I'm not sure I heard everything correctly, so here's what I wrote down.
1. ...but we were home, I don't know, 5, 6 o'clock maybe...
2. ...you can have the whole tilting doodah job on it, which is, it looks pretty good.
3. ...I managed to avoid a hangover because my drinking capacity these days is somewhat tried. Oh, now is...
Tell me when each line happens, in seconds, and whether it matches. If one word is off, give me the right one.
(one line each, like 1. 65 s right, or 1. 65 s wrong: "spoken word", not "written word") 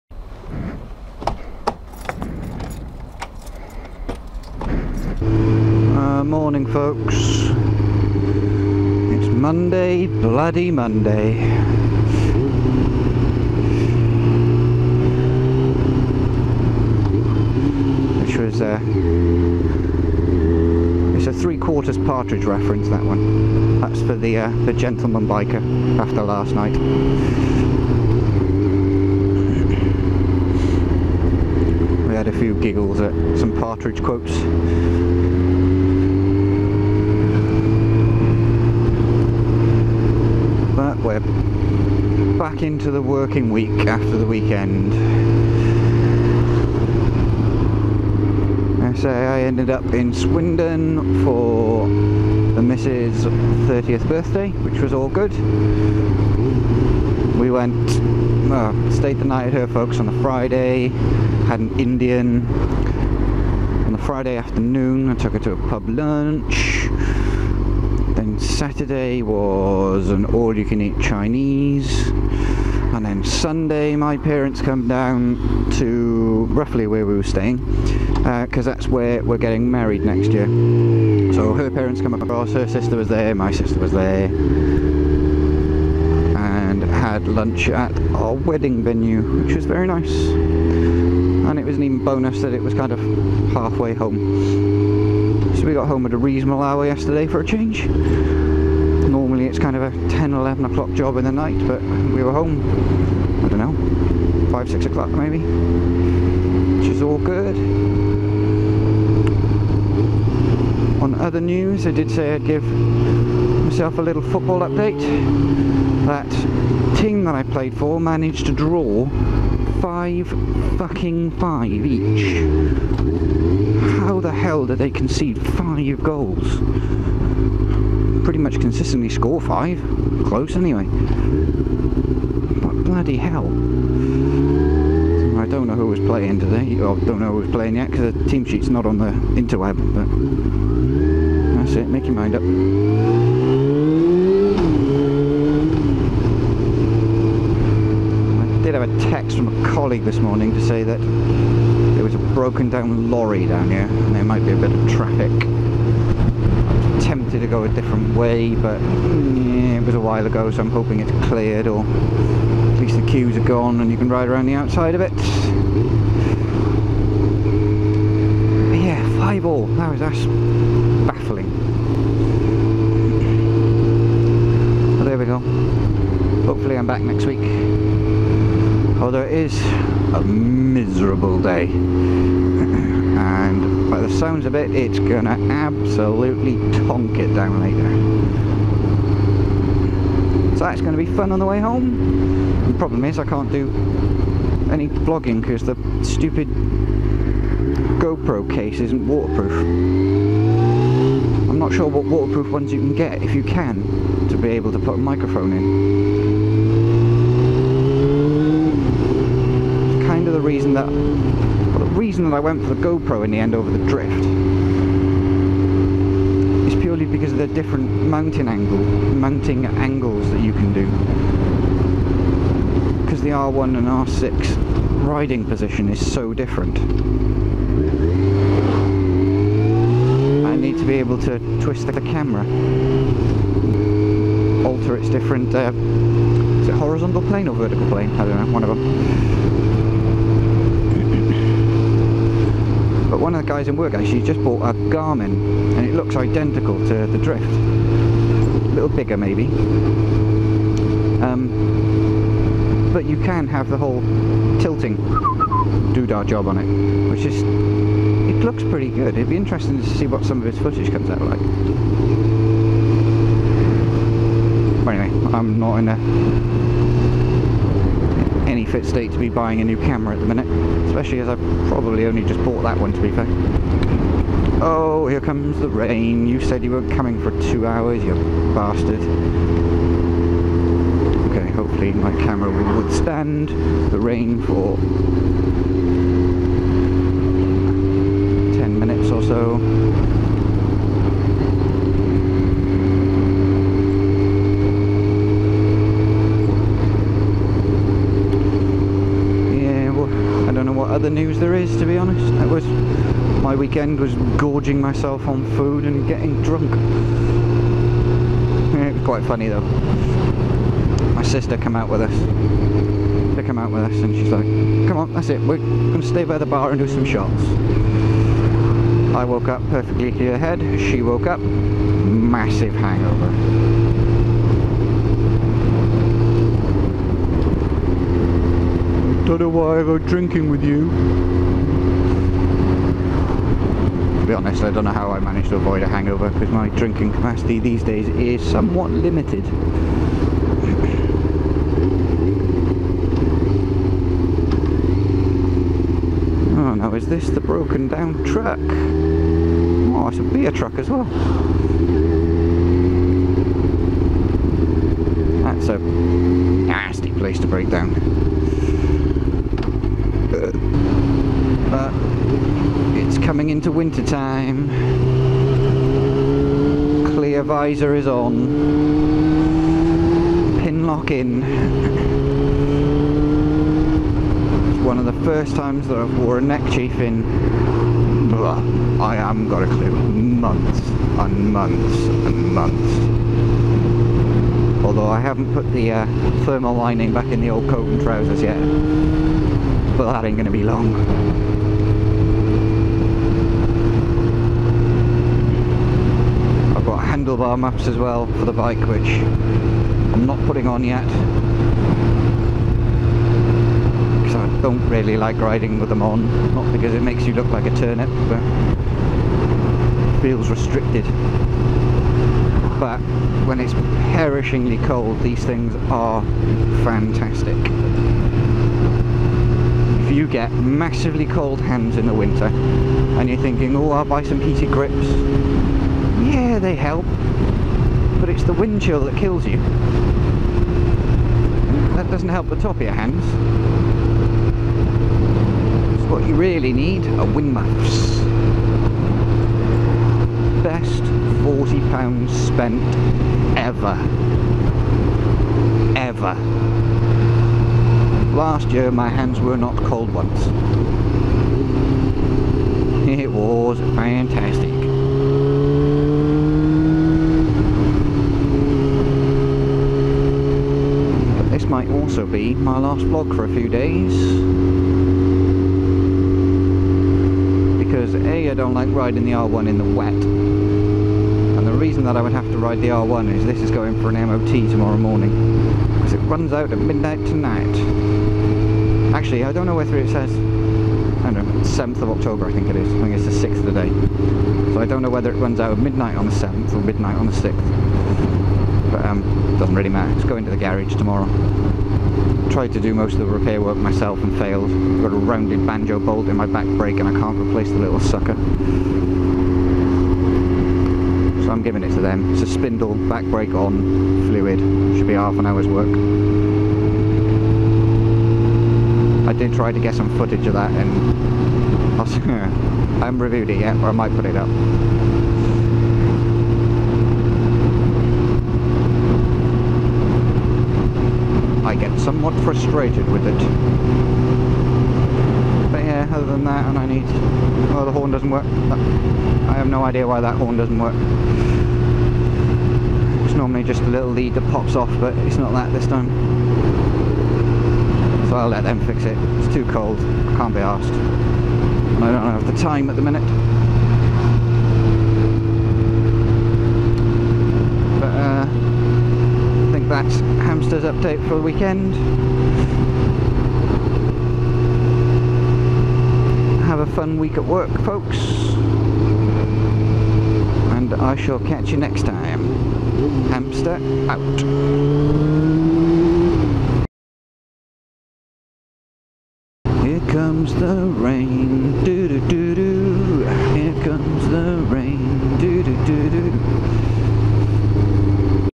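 1. 101 s right
2. 253 s right
3. 335 s wrong: "limited", not "tried".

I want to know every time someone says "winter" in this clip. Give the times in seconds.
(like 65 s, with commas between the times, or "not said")
363 s, 422 s.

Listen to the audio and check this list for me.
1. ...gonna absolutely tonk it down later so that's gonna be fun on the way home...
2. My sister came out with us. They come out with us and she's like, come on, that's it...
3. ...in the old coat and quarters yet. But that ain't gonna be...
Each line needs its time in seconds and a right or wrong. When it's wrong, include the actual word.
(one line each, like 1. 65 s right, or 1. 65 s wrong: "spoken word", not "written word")
1. 184 s right
2. 311 s right
3. 387 s wrong: "trousers", not "quarters".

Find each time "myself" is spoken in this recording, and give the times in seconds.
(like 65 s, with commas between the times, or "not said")
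112 s, 304 s, 493 s.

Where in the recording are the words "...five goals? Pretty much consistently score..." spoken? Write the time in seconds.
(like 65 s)
125 s.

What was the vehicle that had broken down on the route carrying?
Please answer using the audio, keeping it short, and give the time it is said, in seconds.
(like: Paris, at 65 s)
Beer, at 350 s.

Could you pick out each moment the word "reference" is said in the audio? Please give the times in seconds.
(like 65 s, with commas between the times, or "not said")
22 s.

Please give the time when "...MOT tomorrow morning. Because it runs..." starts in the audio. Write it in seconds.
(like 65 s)
474 s.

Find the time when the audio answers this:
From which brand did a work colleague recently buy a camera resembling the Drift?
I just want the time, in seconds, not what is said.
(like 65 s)
244 s.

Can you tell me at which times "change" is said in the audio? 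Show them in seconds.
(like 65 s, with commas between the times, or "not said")
97 s.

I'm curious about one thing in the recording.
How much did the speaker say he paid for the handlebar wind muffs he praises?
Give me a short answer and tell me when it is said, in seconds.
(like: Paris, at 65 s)
£40, at 441 s.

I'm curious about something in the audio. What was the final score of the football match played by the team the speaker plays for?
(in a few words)
5-5.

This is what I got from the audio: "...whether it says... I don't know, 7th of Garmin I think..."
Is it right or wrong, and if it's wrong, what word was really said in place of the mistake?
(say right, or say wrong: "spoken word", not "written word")
wrong: "October", not "Garmin".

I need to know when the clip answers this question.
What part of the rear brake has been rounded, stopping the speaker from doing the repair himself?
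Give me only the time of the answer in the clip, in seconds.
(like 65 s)
495 s.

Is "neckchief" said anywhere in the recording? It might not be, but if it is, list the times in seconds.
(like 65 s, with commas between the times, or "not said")
376 s.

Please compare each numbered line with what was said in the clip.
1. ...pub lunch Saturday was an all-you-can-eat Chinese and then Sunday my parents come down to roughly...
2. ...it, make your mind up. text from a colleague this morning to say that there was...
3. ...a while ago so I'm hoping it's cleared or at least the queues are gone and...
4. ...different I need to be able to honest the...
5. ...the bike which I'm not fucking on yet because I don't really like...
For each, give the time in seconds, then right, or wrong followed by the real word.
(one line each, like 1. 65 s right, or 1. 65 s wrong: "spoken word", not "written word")
1. 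65 s right
2. 141 s right
3. 159 s right
4. 226 s wrong: "twist", not "honest"
5. 398 s wrong: "putting", not "fucking".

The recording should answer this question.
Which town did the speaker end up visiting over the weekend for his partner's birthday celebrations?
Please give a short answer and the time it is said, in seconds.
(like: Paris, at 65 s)
Swindon, at 50 s.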